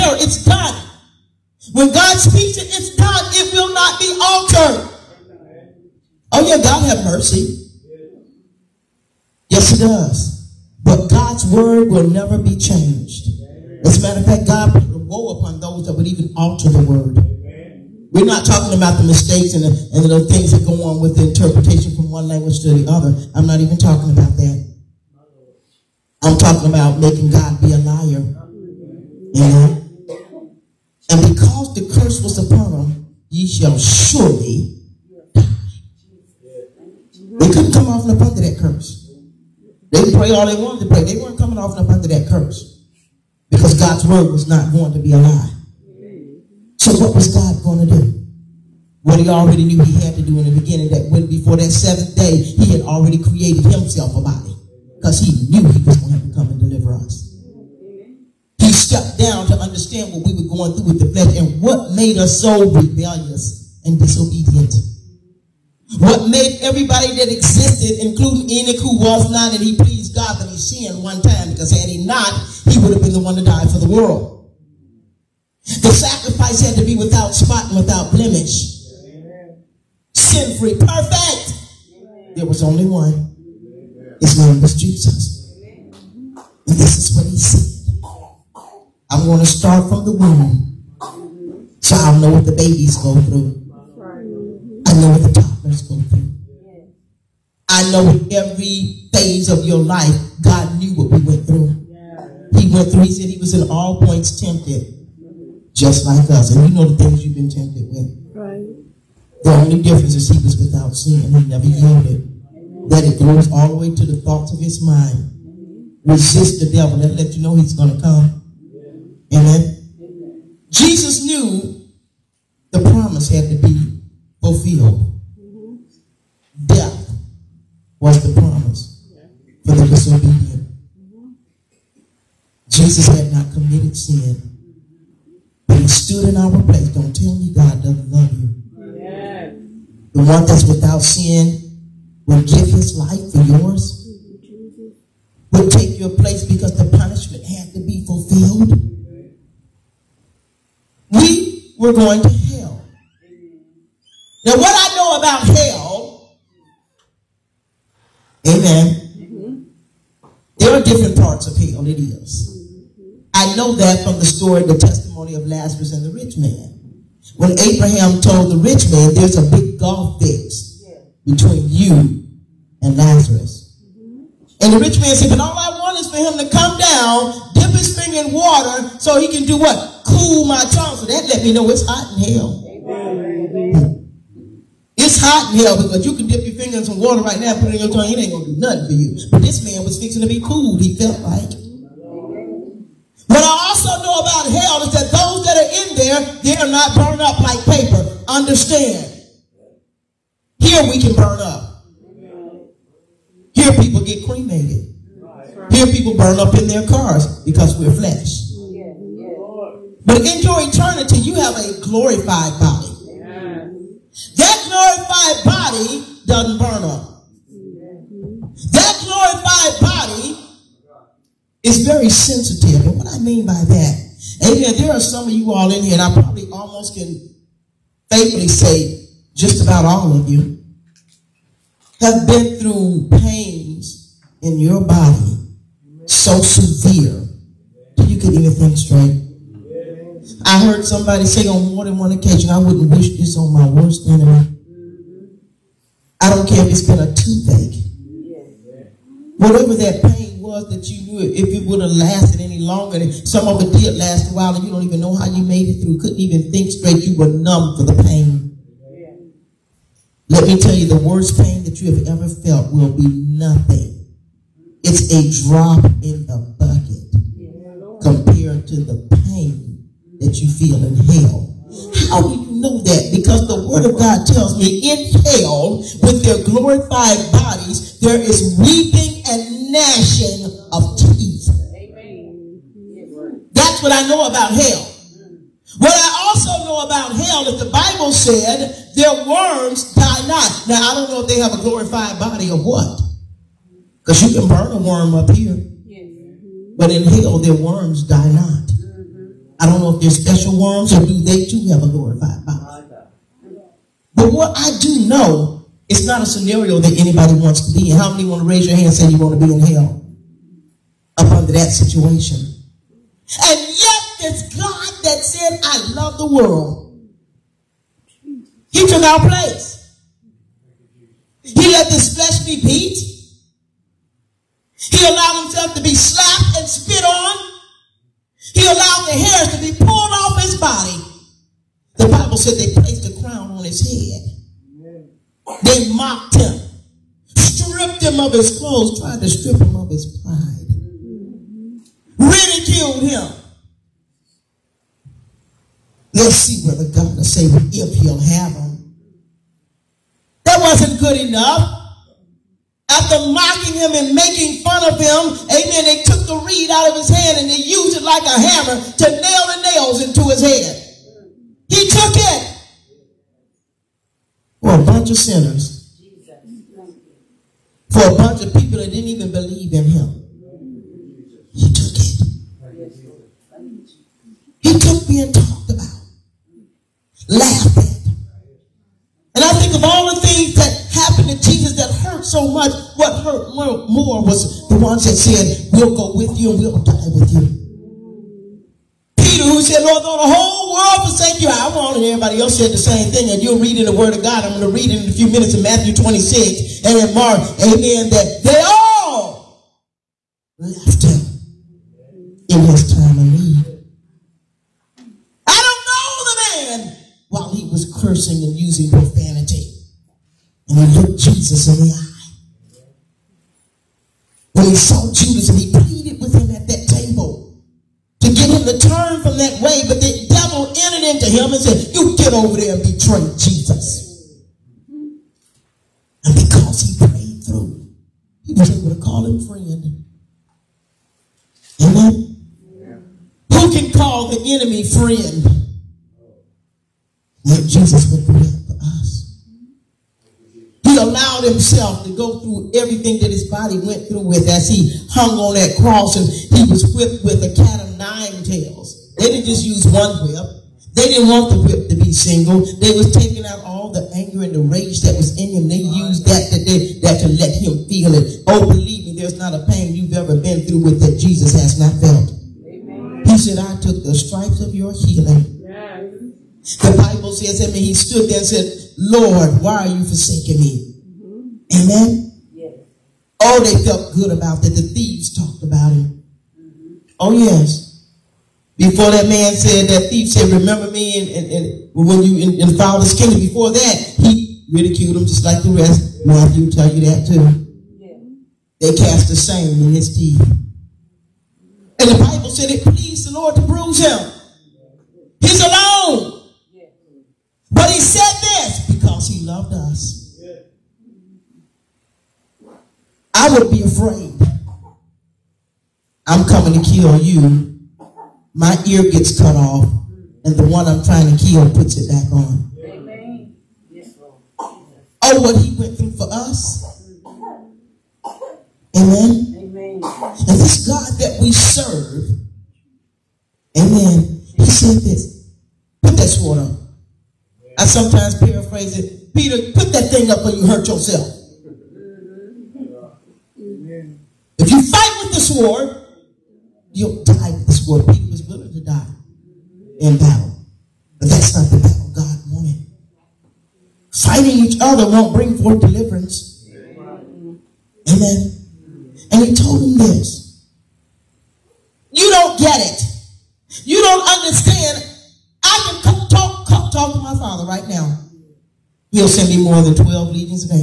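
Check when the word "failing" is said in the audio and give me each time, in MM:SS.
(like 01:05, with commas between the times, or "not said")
not said.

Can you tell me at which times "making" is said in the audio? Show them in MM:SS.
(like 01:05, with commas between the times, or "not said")
00:26, 05:54.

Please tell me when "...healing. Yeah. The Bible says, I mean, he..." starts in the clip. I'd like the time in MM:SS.
07:44.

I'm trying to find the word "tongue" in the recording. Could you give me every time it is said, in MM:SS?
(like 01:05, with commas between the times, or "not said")
03:00, 03:07.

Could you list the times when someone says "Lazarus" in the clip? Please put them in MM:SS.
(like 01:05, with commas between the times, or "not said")
02:45, 02:52.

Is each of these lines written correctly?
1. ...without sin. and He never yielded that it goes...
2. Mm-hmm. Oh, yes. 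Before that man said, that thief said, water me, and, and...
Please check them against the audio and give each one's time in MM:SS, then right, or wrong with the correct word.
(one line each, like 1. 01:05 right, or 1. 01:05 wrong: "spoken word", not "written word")
1. 01:50 right
2. 07:56 wrong: "remember", not "water".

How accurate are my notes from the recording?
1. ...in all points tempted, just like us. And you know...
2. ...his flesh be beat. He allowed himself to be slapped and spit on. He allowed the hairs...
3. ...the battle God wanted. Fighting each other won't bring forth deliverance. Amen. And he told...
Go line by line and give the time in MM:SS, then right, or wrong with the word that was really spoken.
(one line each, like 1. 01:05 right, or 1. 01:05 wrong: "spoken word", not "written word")
1. 01:43 right
2. 05:21 right
3. 09:01 right.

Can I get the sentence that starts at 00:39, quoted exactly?
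They could pray all they wanted to pray.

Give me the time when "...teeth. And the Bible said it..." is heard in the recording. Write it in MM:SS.
08:10.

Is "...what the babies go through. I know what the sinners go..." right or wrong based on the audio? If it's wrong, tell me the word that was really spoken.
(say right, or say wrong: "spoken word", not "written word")
wrong: "toddlers", not "sinners".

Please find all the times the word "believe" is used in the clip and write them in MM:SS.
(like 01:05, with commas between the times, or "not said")
06:09, 07:38.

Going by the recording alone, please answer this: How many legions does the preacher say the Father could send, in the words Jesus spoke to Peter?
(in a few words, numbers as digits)
More than 12.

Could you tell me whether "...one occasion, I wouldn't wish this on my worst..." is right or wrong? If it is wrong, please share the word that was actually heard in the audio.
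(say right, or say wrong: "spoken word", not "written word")
right.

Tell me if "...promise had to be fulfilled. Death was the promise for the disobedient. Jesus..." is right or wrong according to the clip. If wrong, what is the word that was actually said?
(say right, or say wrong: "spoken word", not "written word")
right.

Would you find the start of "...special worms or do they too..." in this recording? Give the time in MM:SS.
05:00.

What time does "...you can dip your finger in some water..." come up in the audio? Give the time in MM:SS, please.
03:06.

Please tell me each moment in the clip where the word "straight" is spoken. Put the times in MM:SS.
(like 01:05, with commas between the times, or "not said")
03:58, 04:16.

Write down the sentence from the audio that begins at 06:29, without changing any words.
Peter, who said, Lord, though the whole world forsake you, I want it.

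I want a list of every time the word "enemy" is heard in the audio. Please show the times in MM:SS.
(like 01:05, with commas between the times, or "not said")
04:04, 07:14.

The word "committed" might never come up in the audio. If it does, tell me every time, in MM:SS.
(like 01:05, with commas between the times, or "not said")
02:13.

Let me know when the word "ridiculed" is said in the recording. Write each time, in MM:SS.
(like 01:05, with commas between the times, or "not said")
05:42, 08:04.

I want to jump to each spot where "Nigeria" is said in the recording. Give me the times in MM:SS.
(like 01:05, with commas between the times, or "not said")
not said.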